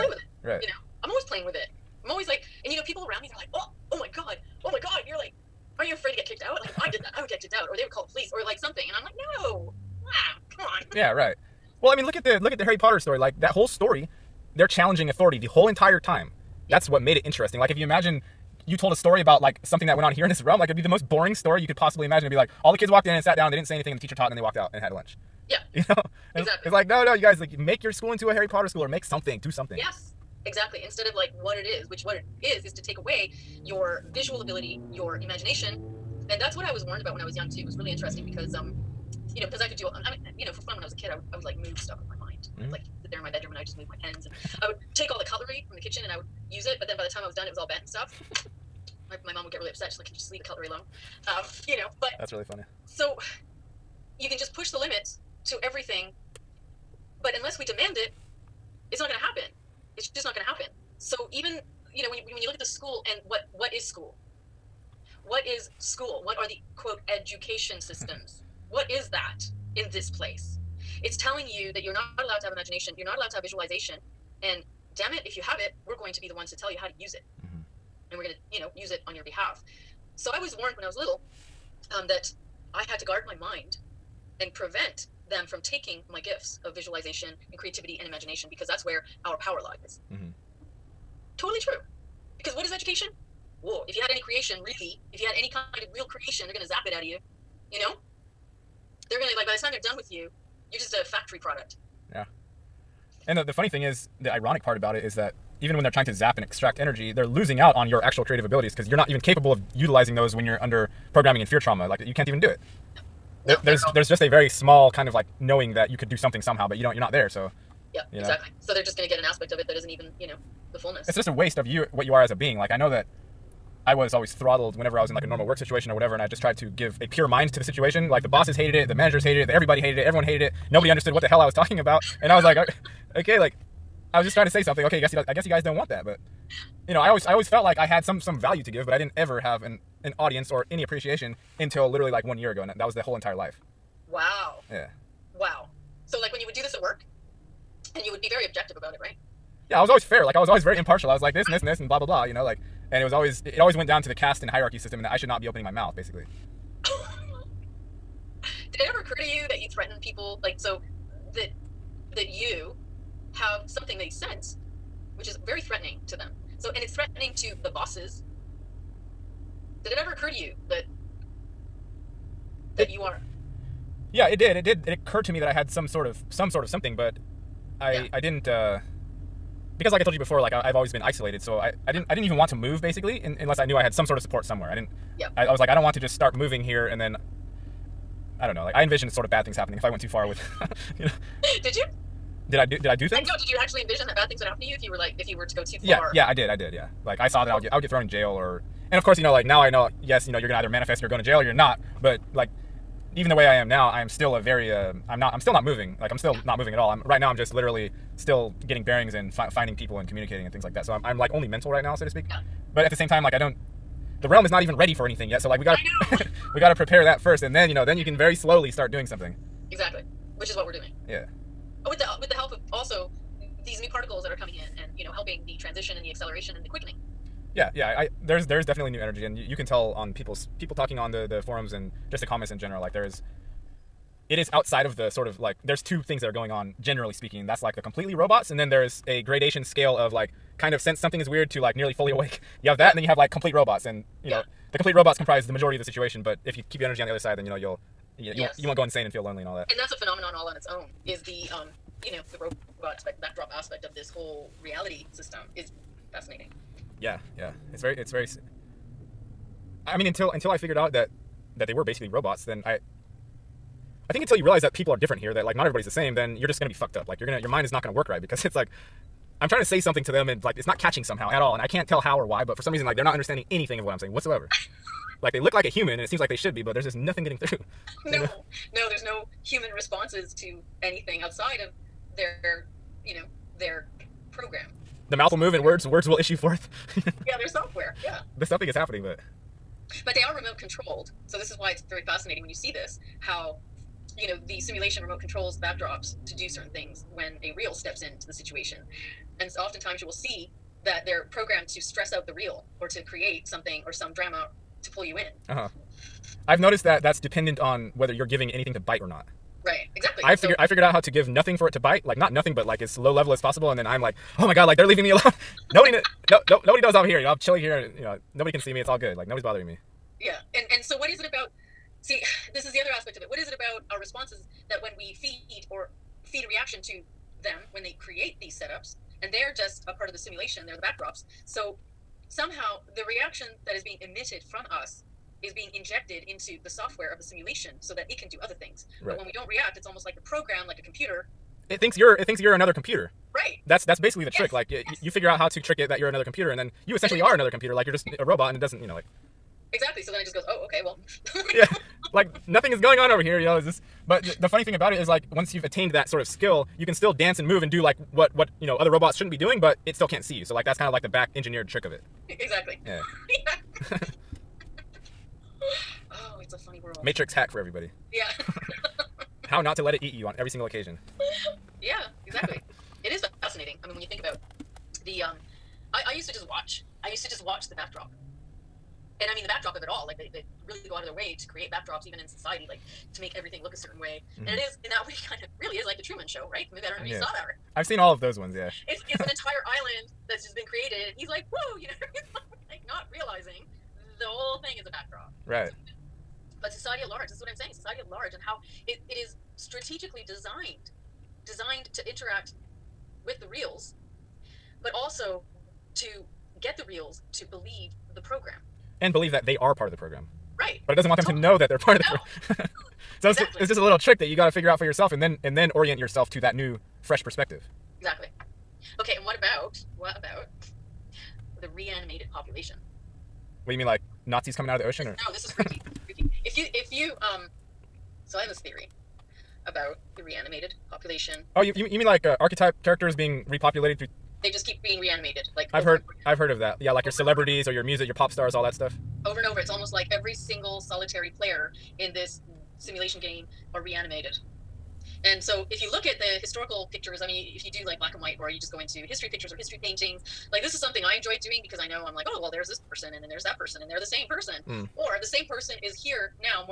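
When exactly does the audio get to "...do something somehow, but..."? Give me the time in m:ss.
1:56.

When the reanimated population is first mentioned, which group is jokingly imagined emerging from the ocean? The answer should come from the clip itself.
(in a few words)
Nazis.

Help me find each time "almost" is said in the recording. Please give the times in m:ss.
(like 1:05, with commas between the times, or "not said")
5:39, 7:19.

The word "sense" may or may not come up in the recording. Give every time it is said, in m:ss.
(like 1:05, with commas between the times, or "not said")
2:44, 4:00.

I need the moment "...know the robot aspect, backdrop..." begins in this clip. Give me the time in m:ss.
4:12.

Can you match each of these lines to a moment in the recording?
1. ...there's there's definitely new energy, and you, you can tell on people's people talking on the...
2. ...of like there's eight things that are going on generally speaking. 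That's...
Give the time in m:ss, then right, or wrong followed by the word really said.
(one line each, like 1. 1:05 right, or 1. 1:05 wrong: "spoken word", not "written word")
1. 3:48 right
2. 3:55 wrong: "two", not "eight".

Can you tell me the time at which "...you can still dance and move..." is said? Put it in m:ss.
5:56.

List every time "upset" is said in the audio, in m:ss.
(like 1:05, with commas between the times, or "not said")
0:49.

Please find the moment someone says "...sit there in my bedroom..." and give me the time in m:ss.
0:43.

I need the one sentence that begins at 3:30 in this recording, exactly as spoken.
So I'm I'm like only mental right now, so to speak.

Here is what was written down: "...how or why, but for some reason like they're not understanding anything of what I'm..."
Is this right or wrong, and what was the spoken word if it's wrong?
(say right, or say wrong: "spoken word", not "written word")
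right.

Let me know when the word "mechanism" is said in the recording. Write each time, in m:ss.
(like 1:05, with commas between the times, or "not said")
not said.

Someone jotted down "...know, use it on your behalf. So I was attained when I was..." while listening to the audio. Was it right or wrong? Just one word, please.
wrong.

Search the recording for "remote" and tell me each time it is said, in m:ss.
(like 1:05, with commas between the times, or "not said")
4:50, 4:55.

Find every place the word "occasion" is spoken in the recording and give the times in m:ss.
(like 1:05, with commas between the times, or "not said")
6:10.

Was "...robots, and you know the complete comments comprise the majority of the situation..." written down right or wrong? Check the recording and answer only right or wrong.
wrong.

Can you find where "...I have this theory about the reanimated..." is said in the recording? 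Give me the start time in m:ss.
7:08.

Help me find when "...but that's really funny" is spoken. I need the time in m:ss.
0:52.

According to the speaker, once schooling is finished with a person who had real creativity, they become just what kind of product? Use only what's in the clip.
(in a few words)
A factory product.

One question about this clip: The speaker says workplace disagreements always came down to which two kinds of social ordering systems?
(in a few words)
Caste and hierarchy.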